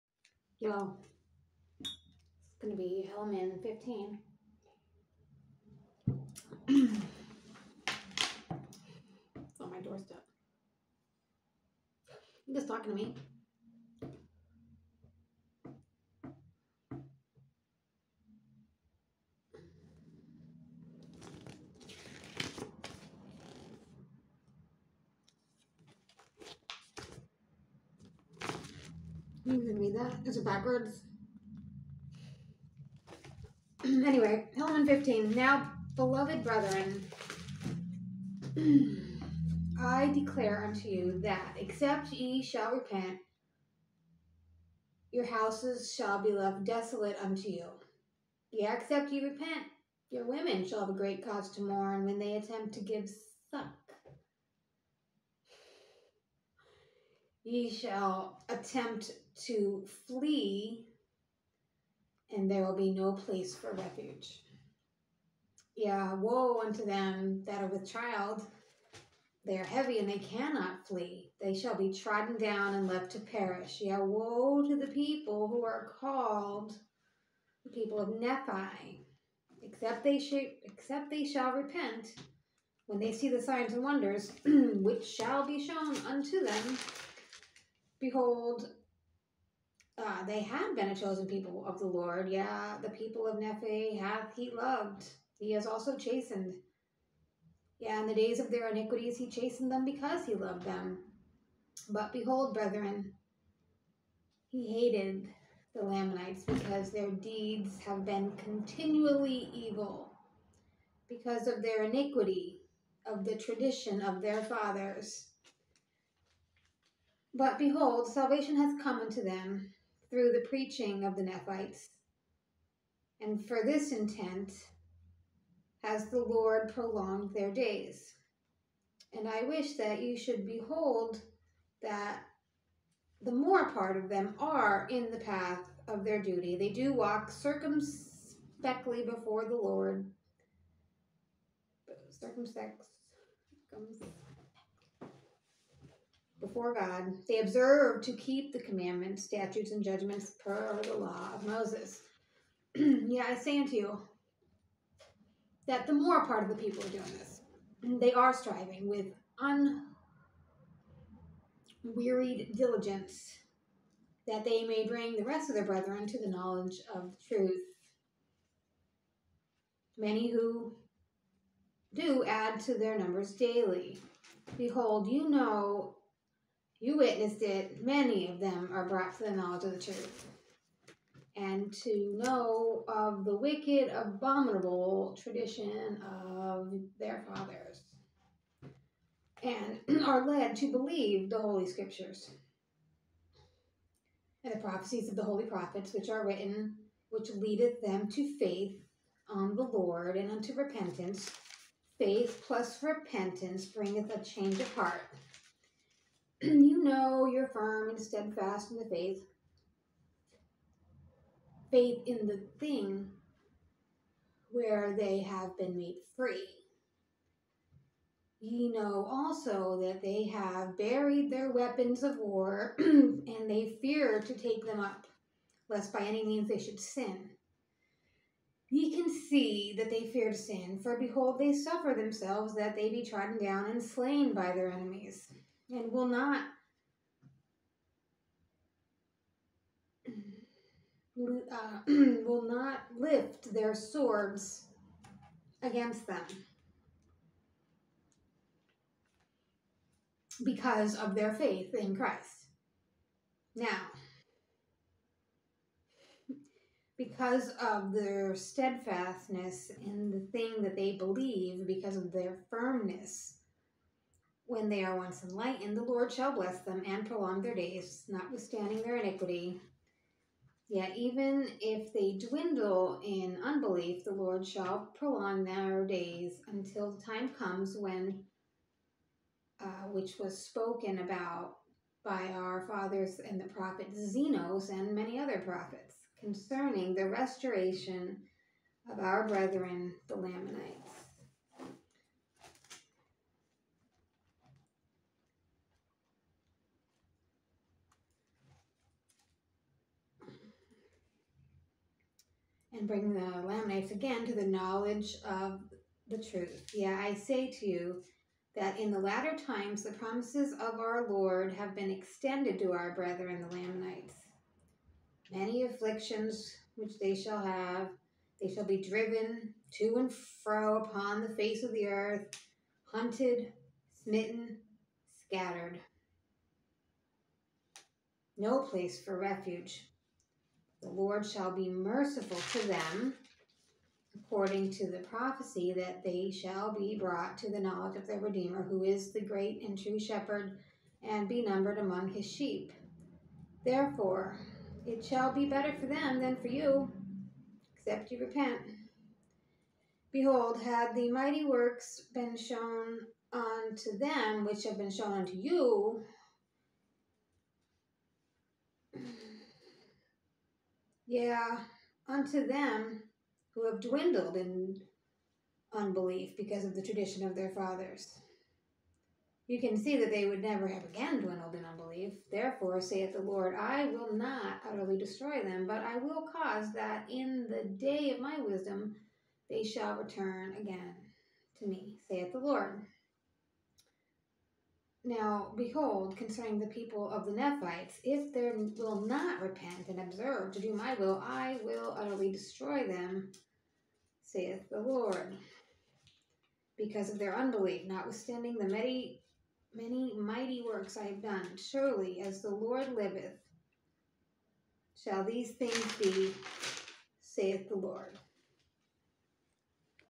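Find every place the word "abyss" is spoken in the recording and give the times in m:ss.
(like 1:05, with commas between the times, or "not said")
not said.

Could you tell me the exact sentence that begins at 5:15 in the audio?
Many afflictions which they shall have, they shall be driven to and fro upon the face of the earth, hunted, smitten, scattered.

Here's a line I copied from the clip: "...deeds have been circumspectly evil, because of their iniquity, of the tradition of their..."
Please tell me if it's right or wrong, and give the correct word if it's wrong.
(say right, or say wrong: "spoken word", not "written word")
wrong: "continually", not "circumspectly".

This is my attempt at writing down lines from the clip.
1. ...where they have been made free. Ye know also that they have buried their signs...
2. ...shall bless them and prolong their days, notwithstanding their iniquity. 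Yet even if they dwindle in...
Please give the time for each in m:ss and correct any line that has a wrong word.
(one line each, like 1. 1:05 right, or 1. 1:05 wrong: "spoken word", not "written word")
1. 3:34 wrong: "weapons", not "signs"
2. 4:26 right.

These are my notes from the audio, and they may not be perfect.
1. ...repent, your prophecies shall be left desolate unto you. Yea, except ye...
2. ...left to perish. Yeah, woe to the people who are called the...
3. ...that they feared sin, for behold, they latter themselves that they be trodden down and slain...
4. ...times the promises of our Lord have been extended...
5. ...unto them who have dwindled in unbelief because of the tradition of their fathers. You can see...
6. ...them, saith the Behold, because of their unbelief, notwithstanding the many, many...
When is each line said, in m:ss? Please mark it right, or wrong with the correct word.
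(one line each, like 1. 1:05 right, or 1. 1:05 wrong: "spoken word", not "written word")
1. 0:42 wrong: "houses", not "prophecies"
2. 1:12 right
3. 3:49 wrong: "suffer", not "latter"
4. 5:09 right
5. 6:02 right
6. 6:32 wrong: "Lord", not "Behold".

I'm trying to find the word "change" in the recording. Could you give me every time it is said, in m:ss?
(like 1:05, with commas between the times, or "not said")
3:24.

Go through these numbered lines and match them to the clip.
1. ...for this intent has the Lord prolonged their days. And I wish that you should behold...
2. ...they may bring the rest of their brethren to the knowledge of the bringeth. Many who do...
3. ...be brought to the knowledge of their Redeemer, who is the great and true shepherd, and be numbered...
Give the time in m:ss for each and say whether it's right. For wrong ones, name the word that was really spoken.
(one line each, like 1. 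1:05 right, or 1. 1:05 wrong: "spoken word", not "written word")
1. 2:03 right
2. 2:44 wrong: "truth", not "bringeth"
3. 5:36 right.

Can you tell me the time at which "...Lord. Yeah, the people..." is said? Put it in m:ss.
1:31.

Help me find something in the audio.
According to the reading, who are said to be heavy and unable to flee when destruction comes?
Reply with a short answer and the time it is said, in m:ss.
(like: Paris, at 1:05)
them that are with child, at 1:06.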